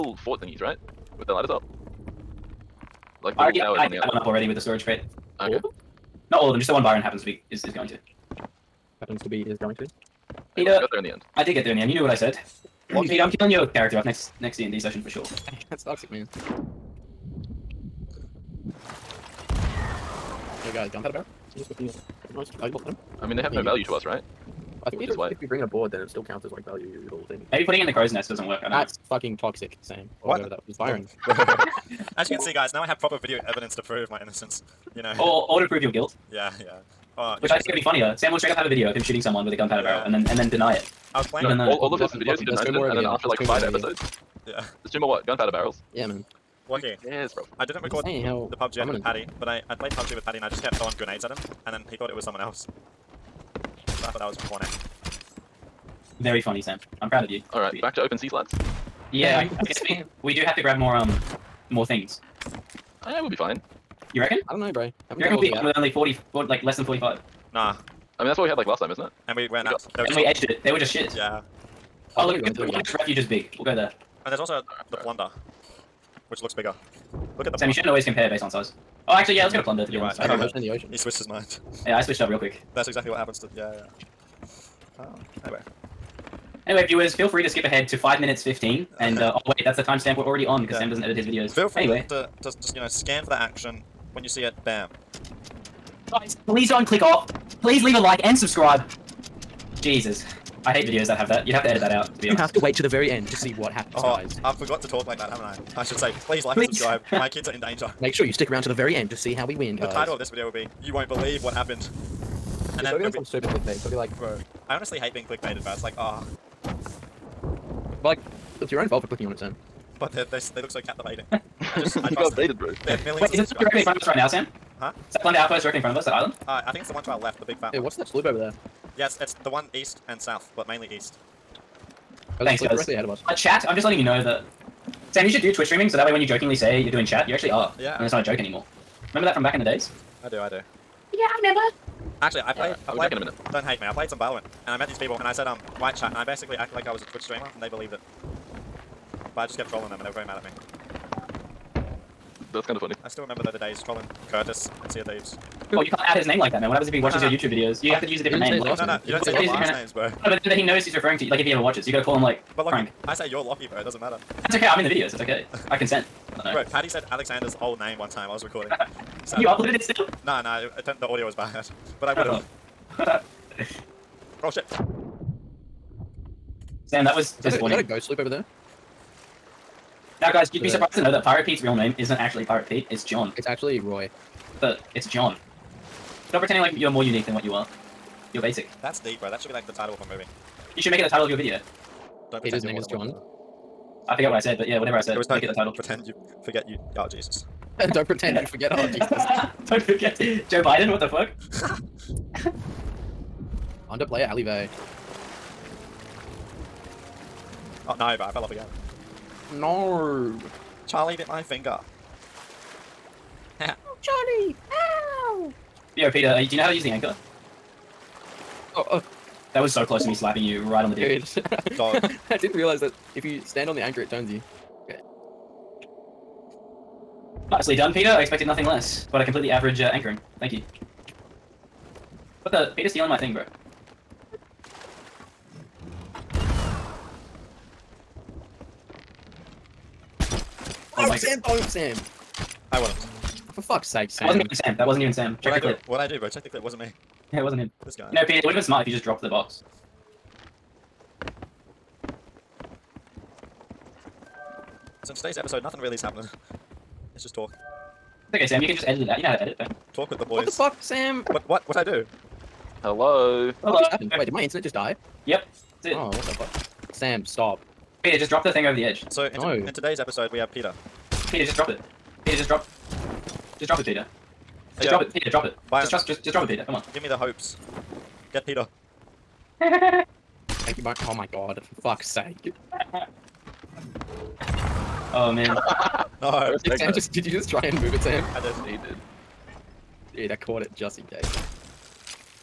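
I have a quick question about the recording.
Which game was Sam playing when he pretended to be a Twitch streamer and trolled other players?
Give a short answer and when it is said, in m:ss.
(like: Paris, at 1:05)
Valorant, at 2:24.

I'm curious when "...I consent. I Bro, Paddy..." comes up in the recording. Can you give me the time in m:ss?
2:45.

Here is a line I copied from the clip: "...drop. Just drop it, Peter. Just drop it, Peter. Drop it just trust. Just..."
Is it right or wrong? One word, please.
right.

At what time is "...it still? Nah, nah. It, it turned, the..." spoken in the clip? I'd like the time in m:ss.
2:49.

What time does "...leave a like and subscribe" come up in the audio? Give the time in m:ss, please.
1:37.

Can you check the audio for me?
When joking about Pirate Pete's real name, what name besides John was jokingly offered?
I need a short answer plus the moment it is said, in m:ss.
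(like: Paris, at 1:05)
Roy, at 3:03.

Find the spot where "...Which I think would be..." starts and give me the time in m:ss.
0:37.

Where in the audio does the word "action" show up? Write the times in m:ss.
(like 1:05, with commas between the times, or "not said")
1:33.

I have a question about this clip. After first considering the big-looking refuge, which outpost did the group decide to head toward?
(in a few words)
Plunder Outpost.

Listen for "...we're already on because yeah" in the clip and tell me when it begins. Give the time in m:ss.
1:30.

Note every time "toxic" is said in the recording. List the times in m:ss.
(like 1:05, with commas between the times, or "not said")
0:15, 0:29.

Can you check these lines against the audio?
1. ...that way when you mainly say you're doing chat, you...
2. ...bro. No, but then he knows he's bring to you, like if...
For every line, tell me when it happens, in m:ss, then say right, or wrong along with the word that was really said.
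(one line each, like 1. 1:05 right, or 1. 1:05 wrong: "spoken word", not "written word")
1. 2:15 wrong: "jokingly", not "mainly"
2. 2:39 wrong: "referring", not "bring".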